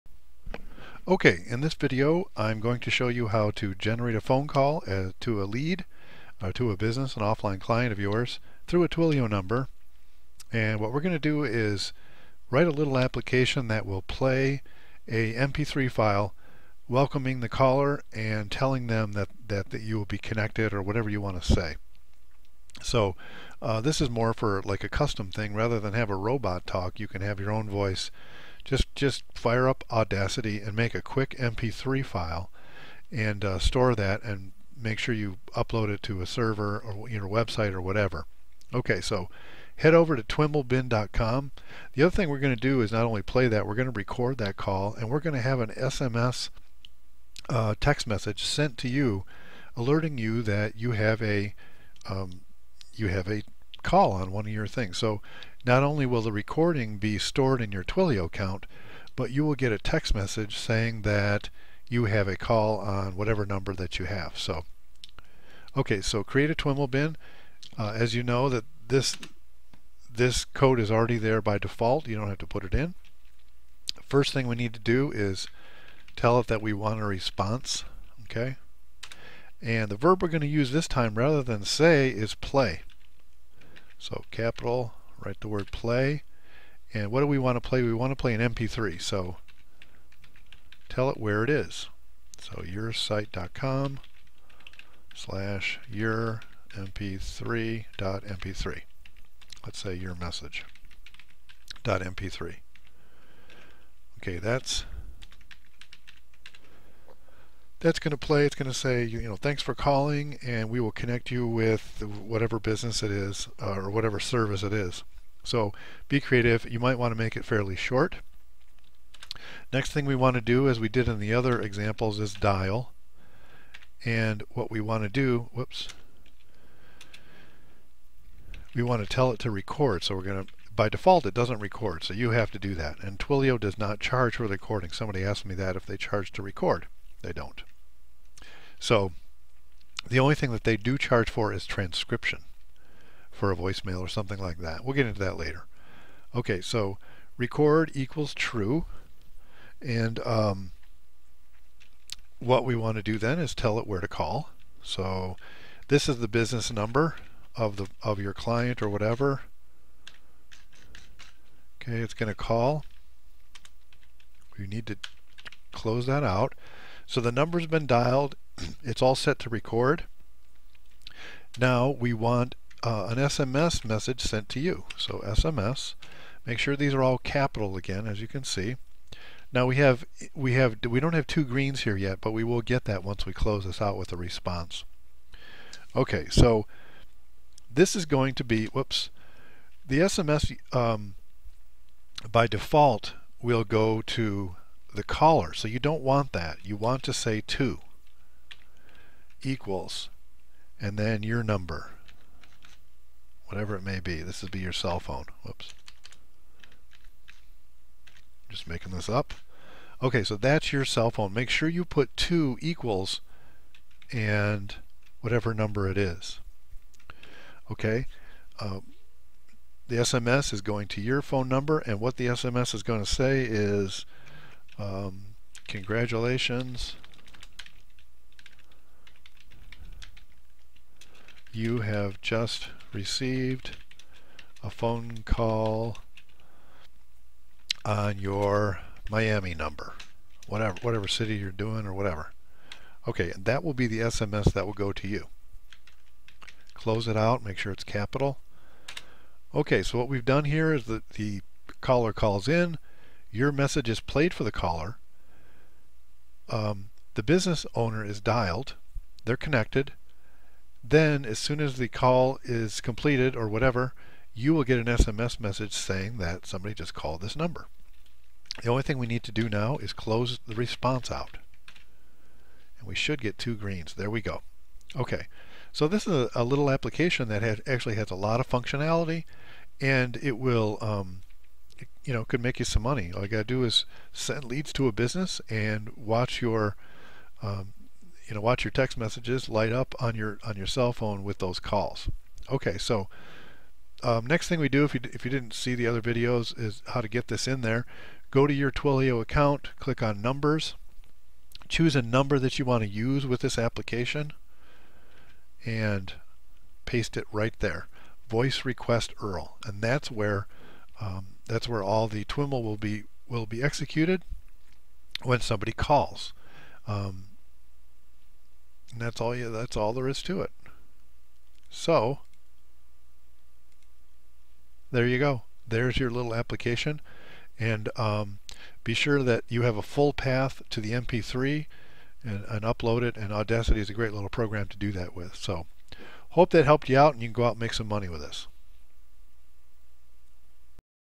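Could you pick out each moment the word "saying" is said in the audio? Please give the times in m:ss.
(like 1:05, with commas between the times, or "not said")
1:00, 4:25.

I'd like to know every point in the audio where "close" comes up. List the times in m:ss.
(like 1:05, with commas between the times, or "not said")
2:45, 3:03, 4:06, 4:29.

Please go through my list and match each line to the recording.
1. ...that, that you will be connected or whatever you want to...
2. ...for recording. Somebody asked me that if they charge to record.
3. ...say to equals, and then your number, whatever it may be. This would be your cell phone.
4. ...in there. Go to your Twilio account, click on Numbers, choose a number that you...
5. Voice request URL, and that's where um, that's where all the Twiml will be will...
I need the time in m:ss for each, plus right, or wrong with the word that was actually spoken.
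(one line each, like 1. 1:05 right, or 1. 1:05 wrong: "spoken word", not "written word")
1. 0:19 right
2. 2:14 right
3. 3:17 right
4. 4:57 right
5. 5:08 right.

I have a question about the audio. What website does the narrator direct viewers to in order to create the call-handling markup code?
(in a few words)
twimlbin.com.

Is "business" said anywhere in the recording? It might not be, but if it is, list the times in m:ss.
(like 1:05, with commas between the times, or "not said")
0:06, 1:52, 2:36, 4:17, 4:44.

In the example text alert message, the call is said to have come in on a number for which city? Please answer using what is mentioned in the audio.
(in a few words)
Miami.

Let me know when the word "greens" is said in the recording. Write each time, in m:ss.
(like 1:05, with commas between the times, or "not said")
3:01, 4:33.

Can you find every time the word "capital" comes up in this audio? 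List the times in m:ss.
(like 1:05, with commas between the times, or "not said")
1:24, 2:57, 4:07.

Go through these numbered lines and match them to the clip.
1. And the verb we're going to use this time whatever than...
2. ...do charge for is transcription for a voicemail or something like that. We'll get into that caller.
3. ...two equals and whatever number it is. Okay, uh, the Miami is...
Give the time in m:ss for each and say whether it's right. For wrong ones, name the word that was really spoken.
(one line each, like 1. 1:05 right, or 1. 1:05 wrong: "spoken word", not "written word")
1. 1:19 wrong: "rather", not "whatever"
2. 2:20 wrong: "later", not "caller"
3. 3:32 wrong: "SMS", not "Miami".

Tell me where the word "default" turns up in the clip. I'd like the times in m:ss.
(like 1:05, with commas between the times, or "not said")
1:11, 2:10, 3:12.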